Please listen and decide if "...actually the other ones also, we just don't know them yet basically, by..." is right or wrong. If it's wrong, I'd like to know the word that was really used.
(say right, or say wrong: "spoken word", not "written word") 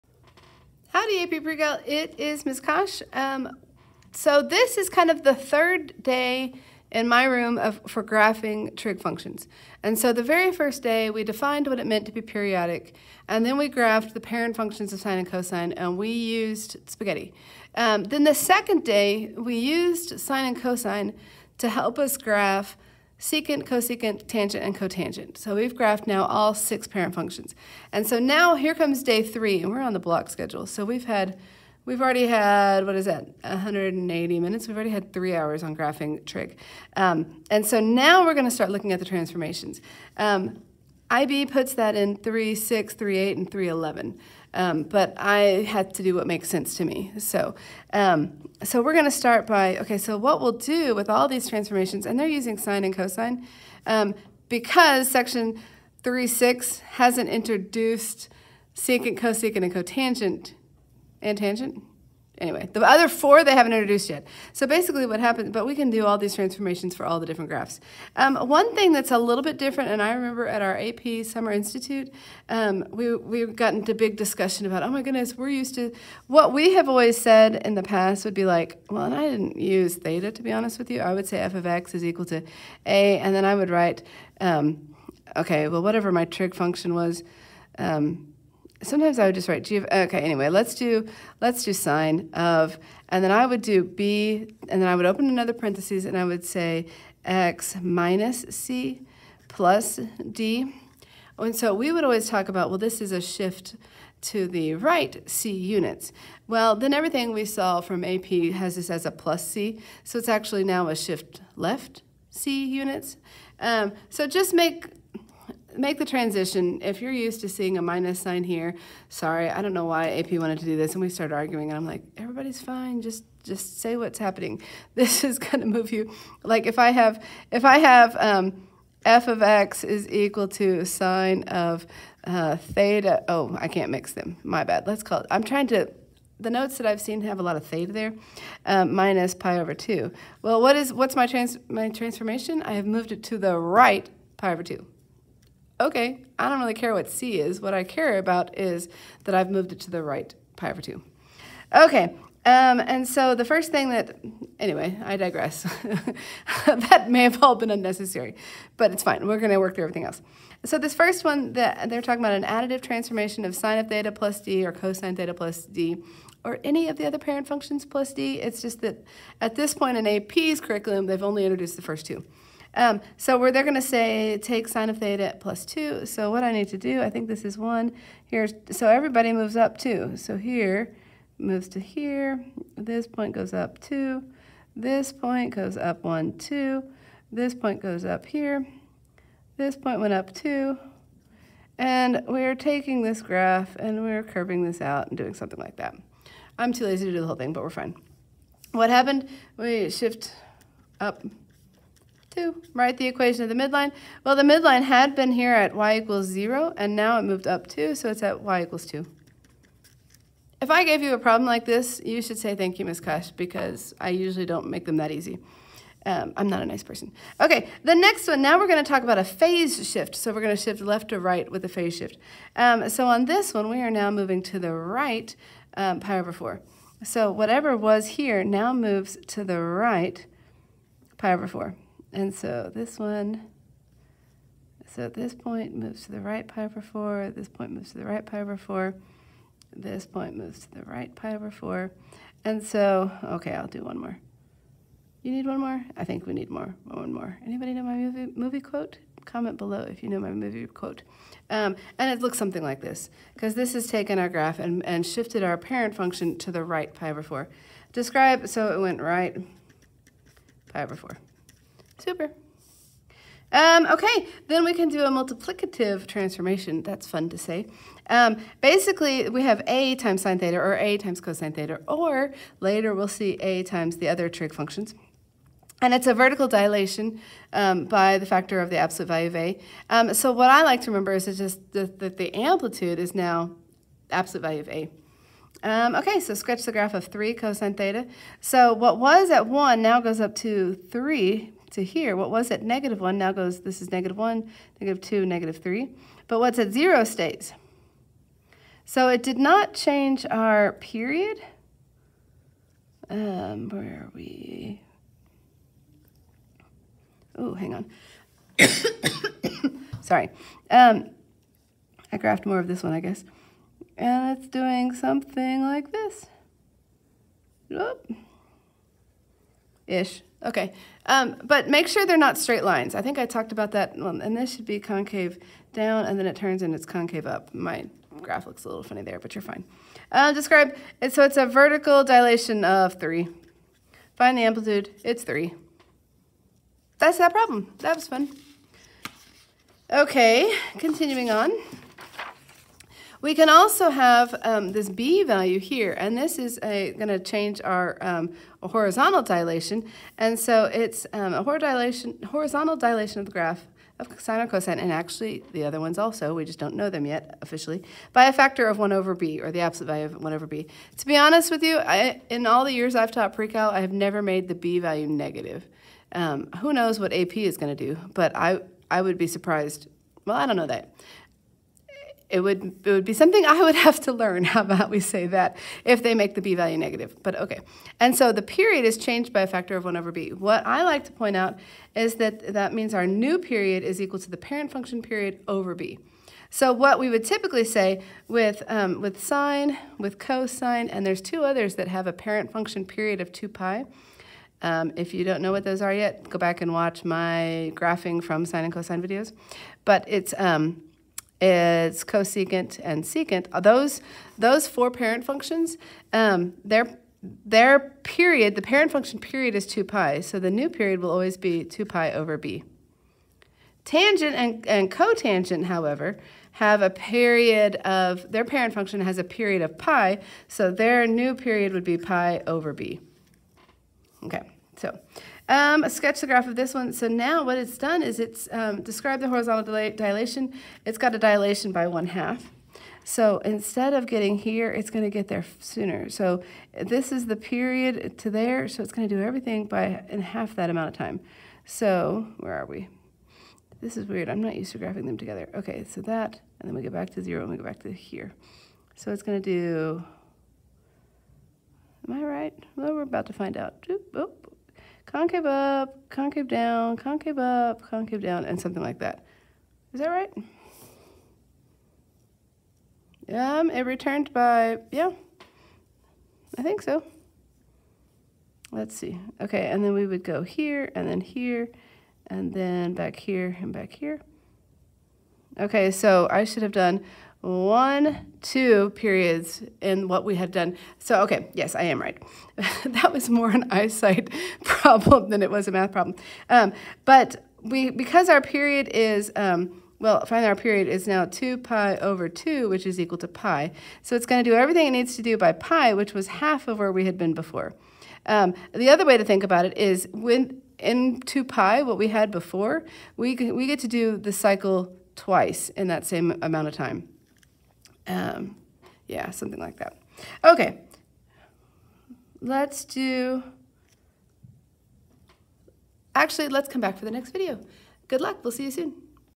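wrong: "officially", not "basically".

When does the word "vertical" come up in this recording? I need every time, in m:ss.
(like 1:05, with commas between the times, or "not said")
4:36, 5:31.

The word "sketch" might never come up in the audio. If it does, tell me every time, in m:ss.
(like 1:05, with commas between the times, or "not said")
4:46, 7:05.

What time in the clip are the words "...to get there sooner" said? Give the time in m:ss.
7:15.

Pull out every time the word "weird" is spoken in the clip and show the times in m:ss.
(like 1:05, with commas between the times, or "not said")
7:24.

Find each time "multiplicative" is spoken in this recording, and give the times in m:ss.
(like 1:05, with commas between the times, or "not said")
4:25.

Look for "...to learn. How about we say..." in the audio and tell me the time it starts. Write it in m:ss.
6:14.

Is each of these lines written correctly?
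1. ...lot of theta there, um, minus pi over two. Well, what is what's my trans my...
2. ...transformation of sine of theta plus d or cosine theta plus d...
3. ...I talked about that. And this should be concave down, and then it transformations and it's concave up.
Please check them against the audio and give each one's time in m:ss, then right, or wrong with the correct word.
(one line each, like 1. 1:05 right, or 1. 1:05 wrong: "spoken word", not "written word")
1. 2:17 right
2. 2:42 right
3. 5:23 wrong: "turns", not "transformations".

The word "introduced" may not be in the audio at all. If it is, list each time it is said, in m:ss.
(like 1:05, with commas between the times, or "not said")
0:57, 1:03, 2:51.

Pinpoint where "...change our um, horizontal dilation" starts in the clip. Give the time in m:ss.
5:47.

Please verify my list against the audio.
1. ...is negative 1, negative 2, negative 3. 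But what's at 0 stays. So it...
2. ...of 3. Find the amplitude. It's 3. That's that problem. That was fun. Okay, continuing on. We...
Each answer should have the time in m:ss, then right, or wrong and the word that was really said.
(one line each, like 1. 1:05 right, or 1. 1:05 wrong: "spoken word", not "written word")
1. 4:53 right
2. 5:32 right.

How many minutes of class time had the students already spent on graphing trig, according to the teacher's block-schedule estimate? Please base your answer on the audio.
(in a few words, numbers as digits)
180.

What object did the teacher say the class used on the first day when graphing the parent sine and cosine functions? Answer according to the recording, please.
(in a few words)
spaghetti.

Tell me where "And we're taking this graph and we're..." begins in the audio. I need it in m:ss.
3:11.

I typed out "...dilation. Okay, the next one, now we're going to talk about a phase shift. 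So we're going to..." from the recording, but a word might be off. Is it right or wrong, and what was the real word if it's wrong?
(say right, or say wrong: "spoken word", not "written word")
wrong: "person", not "dilation".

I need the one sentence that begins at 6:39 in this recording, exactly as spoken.
But it's um, is cosecant and secant.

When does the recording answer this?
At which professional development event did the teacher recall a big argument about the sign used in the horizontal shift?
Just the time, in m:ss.
1:10.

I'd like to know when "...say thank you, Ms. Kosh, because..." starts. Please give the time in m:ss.
3:32.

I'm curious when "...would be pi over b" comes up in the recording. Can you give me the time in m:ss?
7:01.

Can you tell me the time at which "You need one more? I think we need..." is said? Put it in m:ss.
4:05.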